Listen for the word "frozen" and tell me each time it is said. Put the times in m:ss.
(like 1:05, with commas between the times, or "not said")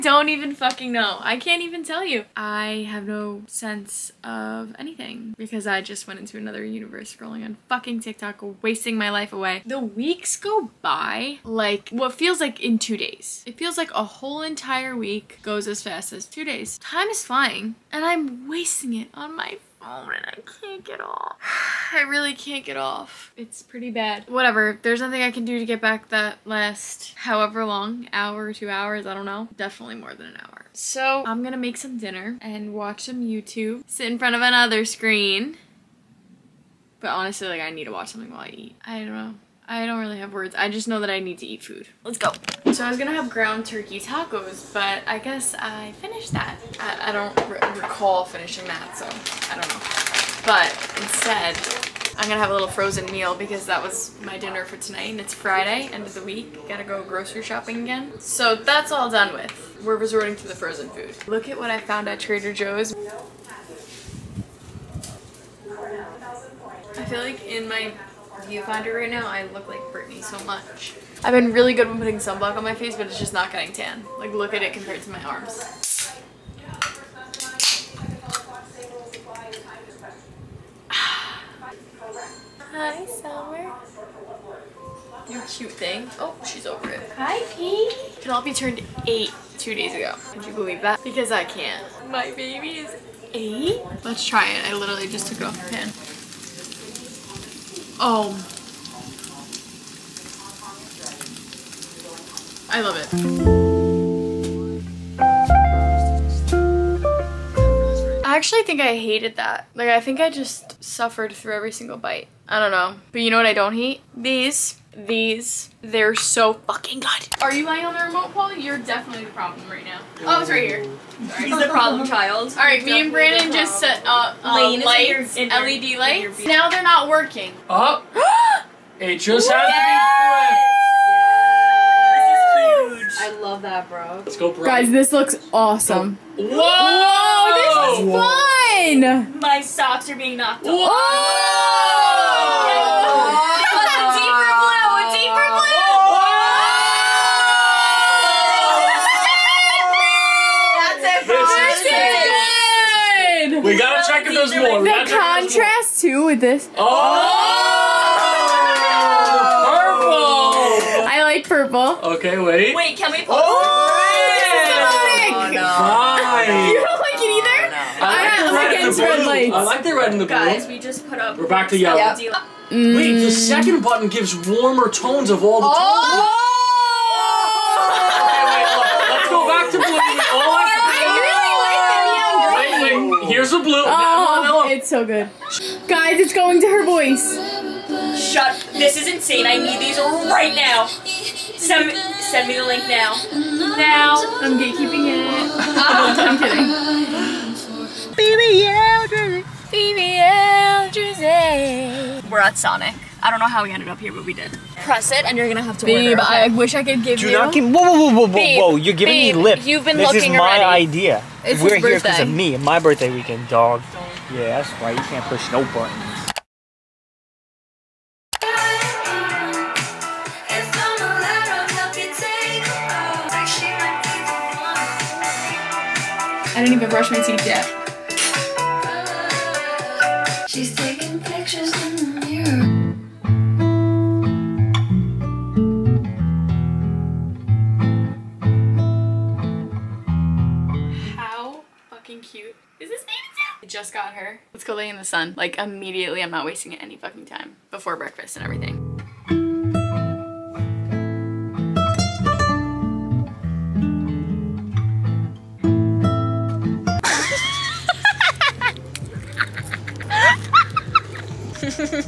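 0:52, 1:00.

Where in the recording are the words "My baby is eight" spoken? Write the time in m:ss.
1:32.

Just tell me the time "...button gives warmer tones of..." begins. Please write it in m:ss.
2:53.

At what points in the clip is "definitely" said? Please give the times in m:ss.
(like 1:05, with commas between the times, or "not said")
0:29, 1:58.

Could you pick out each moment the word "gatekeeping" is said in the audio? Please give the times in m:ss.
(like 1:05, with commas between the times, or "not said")
3:14.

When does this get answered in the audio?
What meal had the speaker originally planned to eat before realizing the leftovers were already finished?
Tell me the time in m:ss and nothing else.
0:43.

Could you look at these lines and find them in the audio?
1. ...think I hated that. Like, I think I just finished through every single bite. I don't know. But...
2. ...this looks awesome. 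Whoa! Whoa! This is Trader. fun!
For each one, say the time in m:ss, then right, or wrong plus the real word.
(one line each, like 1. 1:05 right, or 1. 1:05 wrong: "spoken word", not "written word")
1. 1:48 wrong: "suffered", not "finished"
2. 2:14 wrong: "Whoa", not "Trader".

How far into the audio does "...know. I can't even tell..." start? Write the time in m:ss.
0:00.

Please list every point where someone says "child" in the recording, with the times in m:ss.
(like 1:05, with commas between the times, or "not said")
2:02.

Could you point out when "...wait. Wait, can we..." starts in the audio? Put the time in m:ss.
2:42.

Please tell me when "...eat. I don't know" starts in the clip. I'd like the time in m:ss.
0:38.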